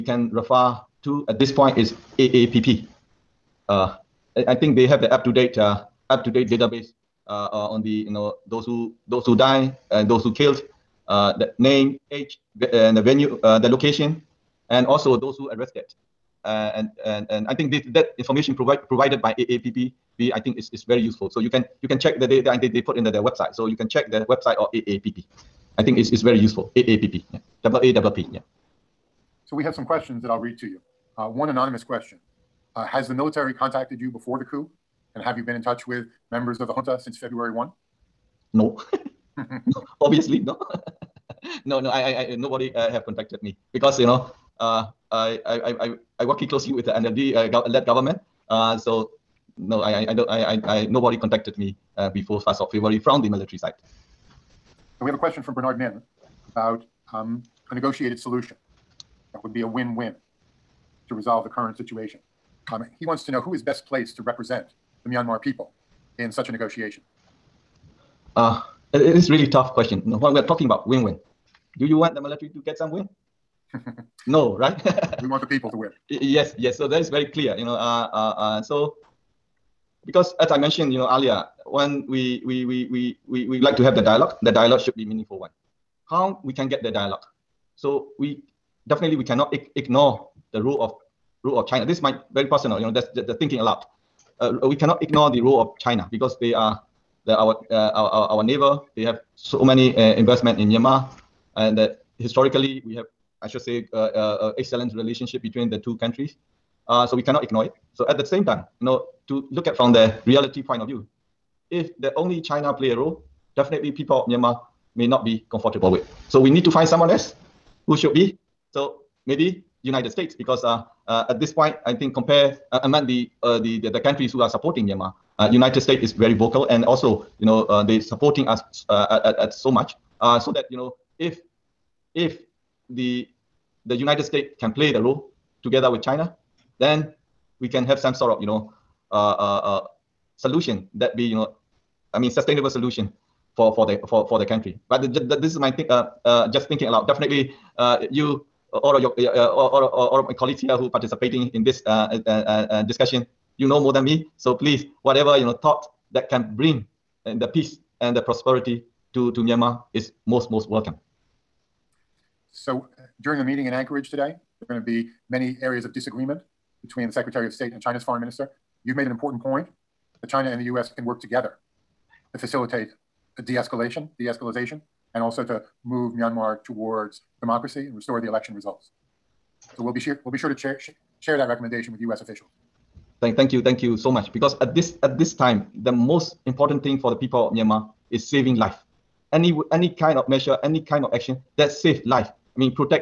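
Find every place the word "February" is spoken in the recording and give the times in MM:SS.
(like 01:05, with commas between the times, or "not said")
00:37, 00:52.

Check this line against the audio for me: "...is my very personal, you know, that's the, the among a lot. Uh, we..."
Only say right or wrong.
wrong.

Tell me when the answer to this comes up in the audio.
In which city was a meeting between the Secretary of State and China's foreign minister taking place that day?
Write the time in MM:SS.
02:43.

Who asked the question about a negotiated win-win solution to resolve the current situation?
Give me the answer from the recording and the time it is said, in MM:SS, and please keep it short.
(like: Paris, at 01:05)
Bernard Min, at 00:55.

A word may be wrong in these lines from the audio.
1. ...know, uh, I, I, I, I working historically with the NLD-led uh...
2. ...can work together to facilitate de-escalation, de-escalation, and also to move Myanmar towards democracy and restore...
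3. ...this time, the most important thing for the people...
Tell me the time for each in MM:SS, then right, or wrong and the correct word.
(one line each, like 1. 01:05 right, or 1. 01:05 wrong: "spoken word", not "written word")
1. 00:44 wrong: "closely", not "historically"
2. 02:50 right
3. 03:05 right.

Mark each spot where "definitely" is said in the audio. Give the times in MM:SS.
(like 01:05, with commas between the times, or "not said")
01:28, 01:53, 02:27.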